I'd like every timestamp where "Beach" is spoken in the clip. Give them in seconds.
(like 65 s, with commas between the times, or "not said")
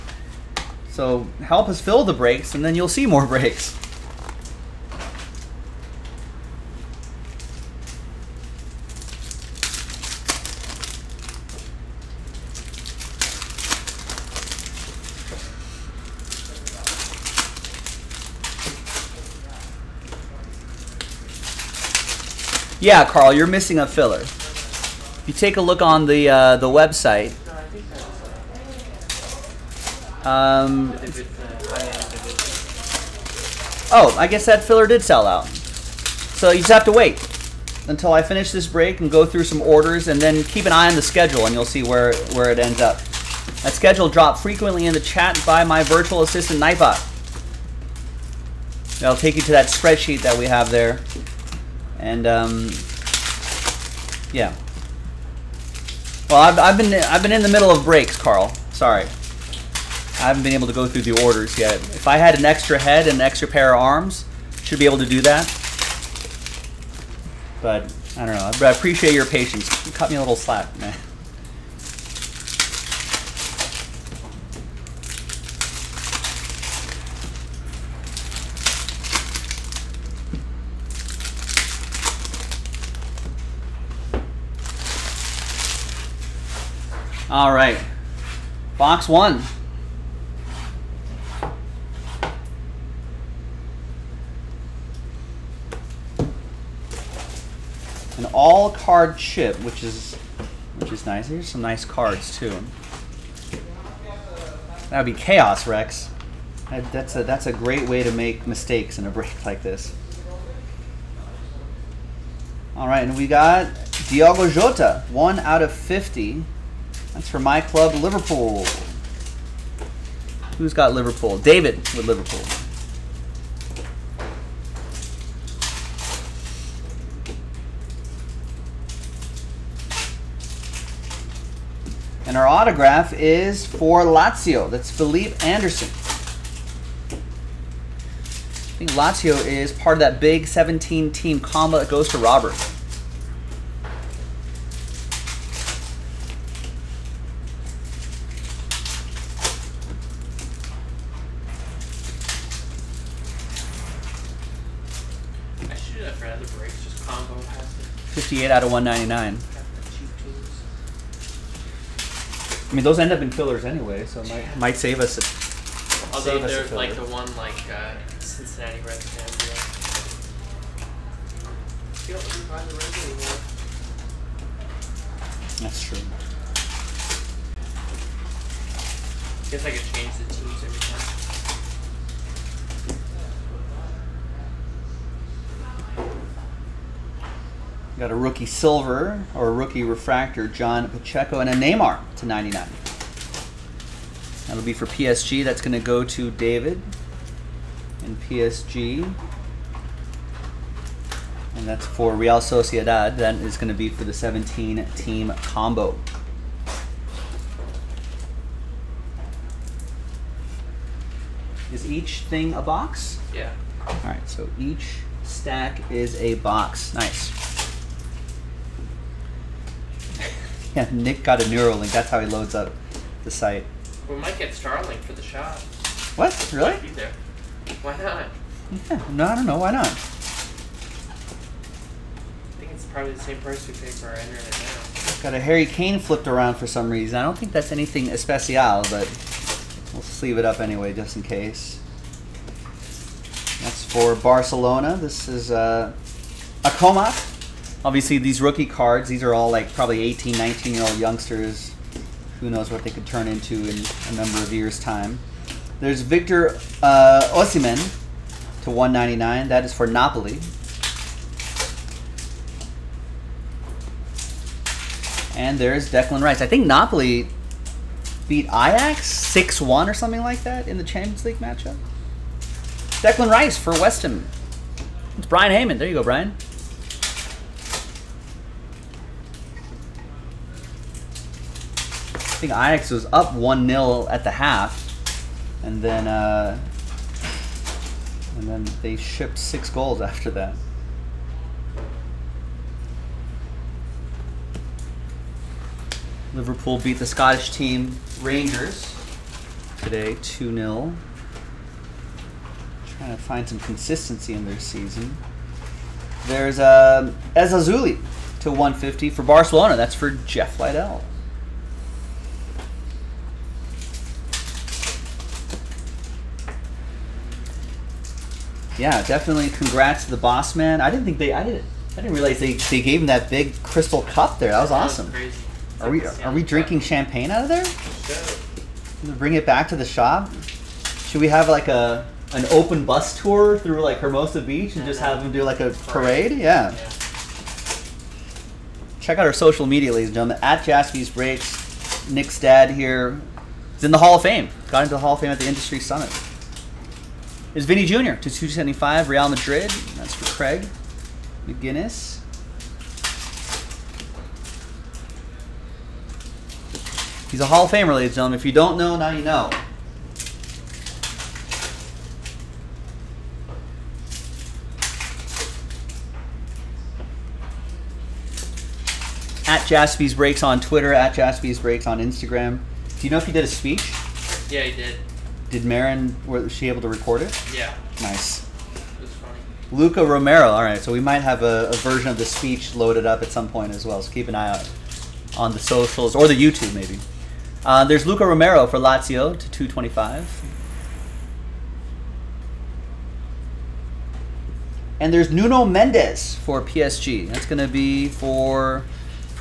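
334 s.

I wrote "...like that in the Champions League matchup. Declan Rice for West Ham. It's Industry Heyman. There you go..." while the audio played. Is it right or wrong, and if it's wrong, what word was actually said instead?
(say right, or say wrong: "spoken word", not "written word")
wrong: "Brian", not "Industry".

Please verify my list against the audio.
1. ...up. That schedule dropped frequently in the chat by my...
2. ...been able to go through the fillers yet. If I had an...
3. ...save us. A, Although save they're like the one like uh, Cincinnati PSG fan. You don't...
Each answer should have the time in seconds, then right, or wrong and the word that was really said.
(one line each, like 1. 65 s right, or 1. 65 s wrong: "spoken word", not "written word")
1. 42 s right
2. 60 s wrong: "orders", not "fillers"
3. 164 s wrong: "Reds", not "PSG".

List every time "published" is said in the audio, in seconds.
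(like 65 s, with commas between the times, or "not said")
not said.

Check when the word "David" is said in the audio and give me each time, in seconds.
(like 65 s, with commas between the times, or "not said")
121 s, 196 s.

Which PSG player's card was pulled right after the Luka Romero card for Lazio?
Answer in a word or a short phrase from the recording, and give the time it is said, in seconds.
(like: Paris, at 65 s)
Nuno Mendes, at 395 s.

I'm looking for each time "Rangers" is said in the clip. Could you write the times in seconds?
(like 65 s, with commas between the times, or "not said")
298 s.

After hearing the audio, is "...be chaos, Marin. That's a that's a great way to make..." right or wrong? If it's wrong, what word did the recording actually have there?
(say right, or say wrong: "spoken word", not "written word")
wrong: "Rex", not "Marin".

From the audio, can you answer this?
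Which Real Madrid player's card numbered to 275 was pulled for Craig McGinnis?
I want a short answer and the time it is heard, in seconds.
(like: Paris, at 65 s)
Vini Jr., at 347 s.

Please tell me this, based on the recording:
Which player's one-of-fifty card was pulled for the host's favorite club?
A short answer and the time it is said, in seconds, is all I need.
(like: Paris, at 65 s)
Diogo Jota, at 114 s.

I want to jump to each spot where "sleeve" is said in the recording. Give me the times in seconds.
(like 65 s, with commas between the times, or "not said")
240 s.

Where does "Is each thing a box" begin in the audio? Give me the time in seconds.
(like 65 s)
211 s.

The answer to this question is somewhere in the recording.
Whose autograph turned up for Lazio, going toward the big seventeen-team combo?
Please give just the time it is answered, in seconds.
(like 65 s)
134 s.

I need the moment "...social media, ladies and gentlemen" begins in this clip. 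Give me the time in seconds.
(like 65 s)
339 s.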